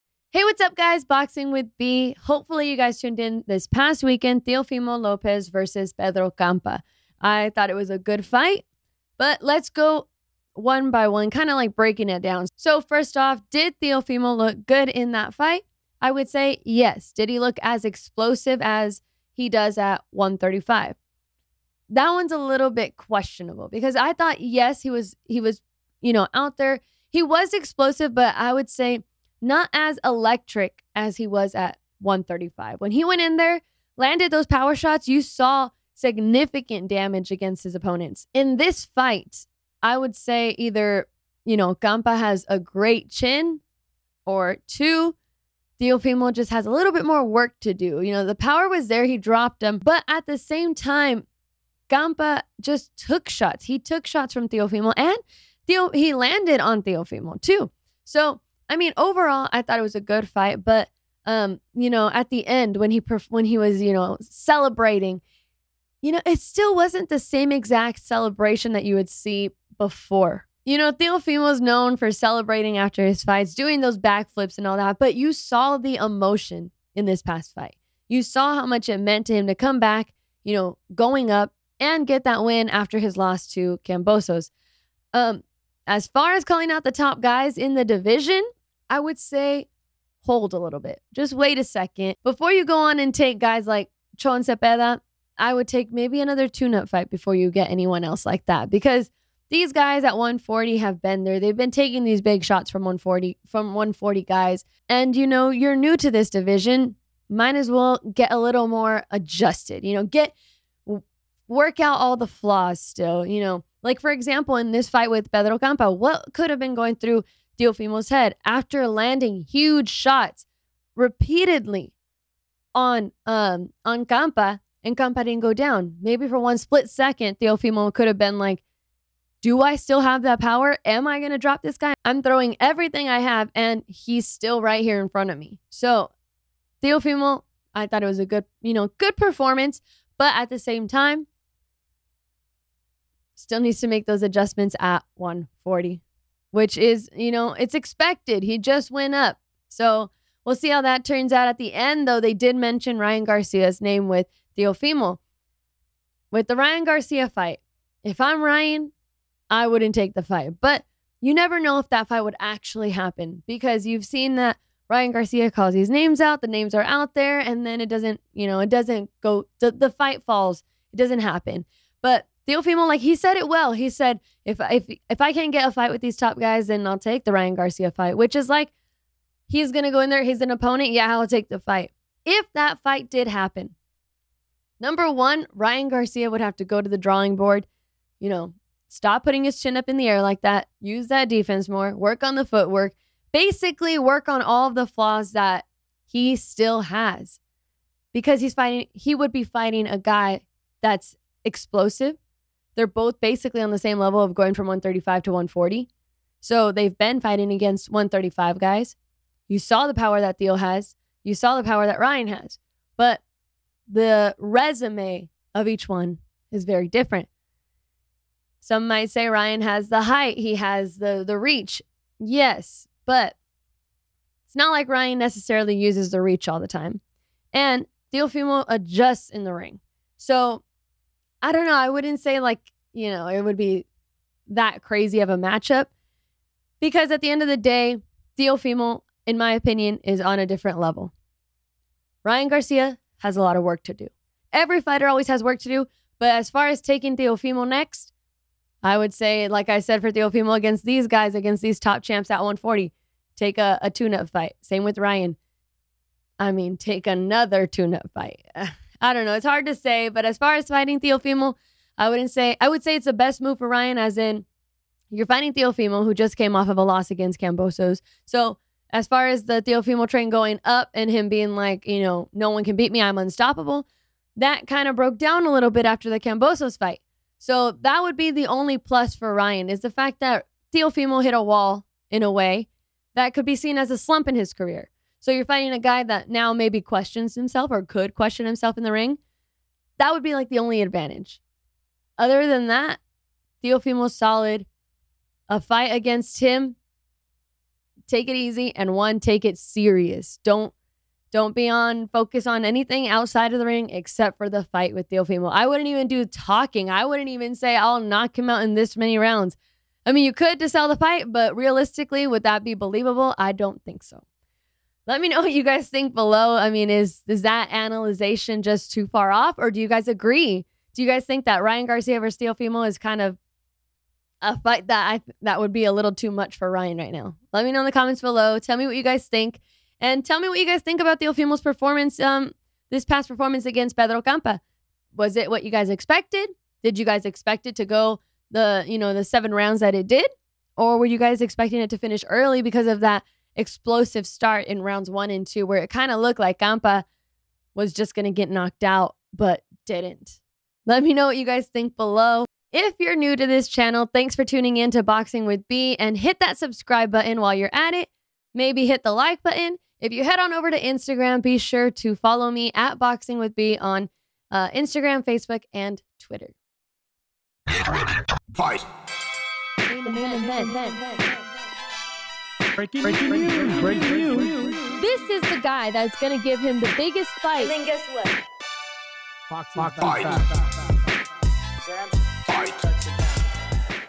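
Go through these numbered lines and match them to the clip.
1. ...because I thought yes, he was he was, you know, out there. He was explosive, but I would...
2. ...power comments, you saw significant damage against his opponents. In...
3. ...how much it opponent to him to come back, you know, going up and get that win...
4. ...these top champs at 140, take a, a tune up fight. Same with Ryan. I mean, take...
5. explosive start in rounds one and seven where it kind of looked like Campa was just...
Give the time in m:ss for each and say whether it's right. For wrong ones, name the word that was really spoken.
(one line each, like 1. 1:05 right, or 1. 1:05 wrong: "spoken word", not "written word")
1. 0:23 right
2. 0:34 wrong: "shots", not "comments"
3. 1:18 wrong: "meant", not "opponent"
4. 4:11 right
5. 5:43 wrong: "two", not "seven".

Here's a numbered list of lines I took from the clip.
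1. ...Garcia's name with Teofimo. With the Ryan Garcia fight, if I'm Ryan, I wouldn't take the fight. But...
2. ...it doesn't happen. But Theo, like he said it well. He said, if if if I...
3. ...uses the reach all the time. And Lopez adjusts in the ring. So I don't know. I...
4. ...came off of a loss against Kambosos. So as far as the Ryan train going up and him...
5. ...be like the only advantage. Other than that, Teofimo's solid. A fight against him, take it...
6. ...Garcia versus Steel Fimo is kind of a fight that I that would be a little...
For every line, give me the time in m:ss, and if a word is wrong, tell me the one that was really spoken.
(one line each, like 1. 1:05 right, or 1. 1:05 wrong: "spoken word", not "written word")
1. 2:33 right
2. 2:50 wrong: "Teofimo", not "Theo"
3. 3:45 wrong: "Fumo", not "Lopez"
4. 4:26 wrong: "Teofimo", not "Ryan"
5. 4:50 right
6. 5:21 right.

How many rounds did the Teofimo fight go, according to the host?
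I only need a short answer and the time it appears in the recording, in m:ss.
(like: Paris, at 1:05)
7, at 5:39.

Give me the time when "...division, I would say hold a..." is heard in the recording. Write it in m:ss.
1:27.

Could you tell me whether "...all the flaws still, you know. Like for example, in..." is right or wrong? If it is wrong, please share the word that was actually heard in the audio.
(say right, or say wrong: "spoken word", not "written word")
right.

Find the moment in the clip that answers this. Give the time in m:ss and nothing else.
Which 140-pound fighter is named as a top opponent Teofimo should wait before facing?
1:34.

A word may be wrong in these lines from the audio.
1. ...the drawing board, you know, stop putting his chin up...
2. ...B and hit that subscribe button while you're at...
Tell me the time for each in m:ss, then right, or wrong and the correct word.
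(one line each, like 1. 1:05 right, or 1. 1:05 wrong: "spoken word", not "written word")
1. 3:06 right
2. 5:55 right.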